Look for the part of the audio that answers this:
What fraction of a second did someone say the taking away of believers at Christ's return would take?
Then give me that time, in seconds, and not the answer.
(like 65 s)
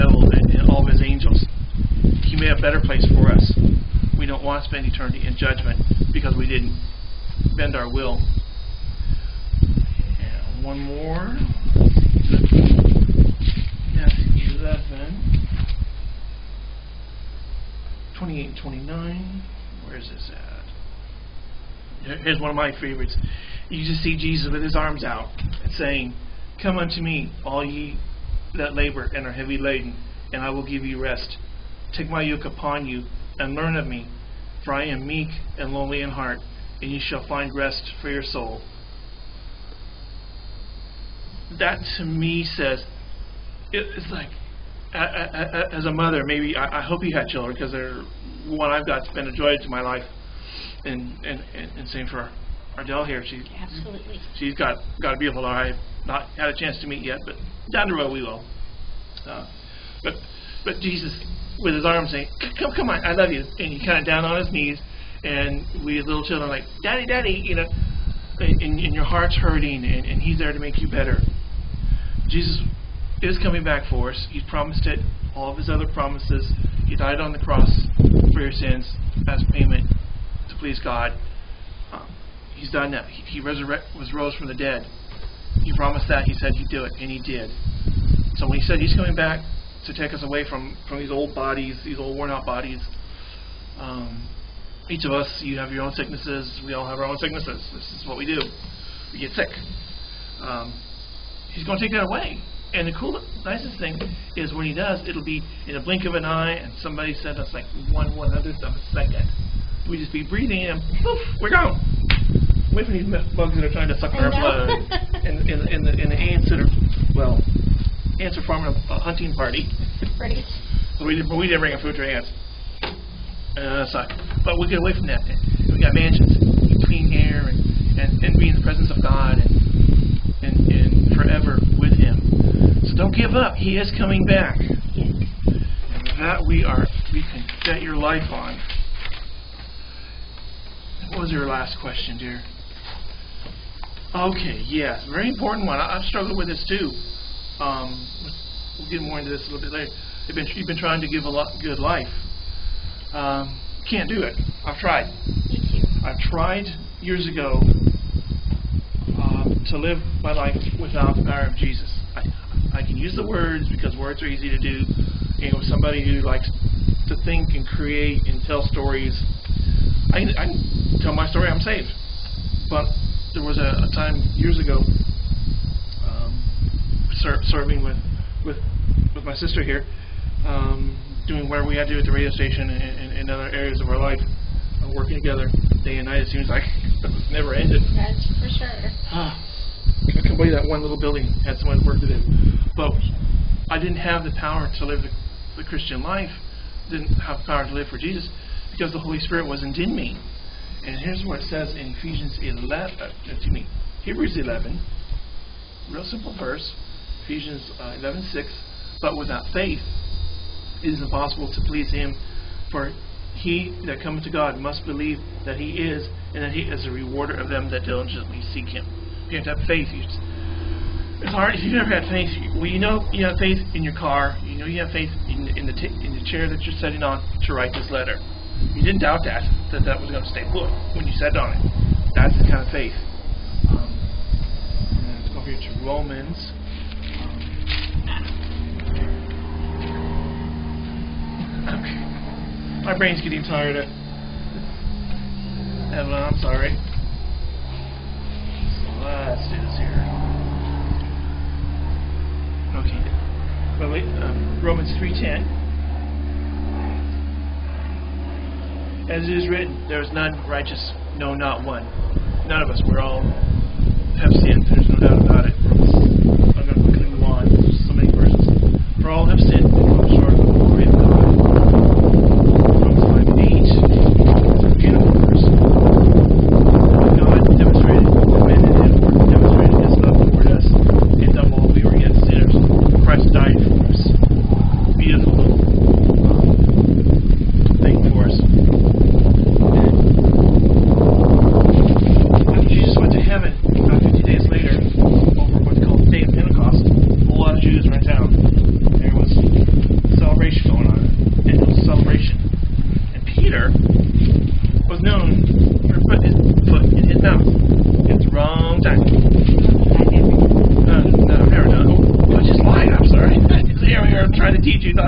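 107 s.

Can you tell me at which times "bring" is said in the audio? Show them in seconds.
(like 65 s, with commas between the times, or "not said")
121 s.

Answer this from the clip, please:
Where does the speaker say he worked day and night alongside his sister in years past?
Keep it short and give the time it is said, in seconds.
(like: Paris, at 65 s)
The radio station, at 182 s.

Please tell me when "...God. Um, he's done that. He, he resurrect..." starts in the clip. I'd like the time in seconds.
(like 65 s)
80 s.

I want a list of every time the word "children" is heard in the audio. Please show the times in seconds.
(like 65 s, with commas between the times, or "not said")
47 s, 66 s.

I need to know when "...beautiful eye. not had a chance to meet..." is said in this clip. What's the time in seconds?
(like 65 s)
55 s.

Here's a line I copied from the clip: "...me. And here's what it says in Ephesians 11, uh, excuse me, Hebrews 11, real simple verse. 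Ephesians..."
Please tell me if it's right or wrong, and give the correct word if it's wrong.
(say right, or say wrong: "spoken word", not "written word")
right.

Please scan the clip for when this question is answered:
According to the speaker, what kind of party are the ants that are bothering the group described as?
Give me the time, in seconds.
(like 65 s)
118 s.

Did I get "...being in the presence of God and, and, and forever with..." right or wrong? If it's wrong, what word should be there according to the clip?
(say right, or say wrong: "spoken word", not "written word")
right.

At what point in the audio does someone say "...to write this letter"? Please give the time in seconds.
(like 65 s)
227 s.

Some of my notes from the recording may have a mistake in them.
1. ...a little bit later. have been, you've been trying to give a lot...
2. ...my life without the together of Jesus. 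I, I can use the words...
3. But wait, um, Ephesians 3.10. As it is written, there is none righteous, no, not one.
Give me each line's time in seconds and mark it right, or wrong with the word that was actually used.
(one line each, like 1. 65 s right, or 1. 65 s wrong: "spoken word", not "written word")
1. 149 s right
2. 160 s wrong: "power", not "together"
3. 253 s wrong: "Romans", not "Ephesians".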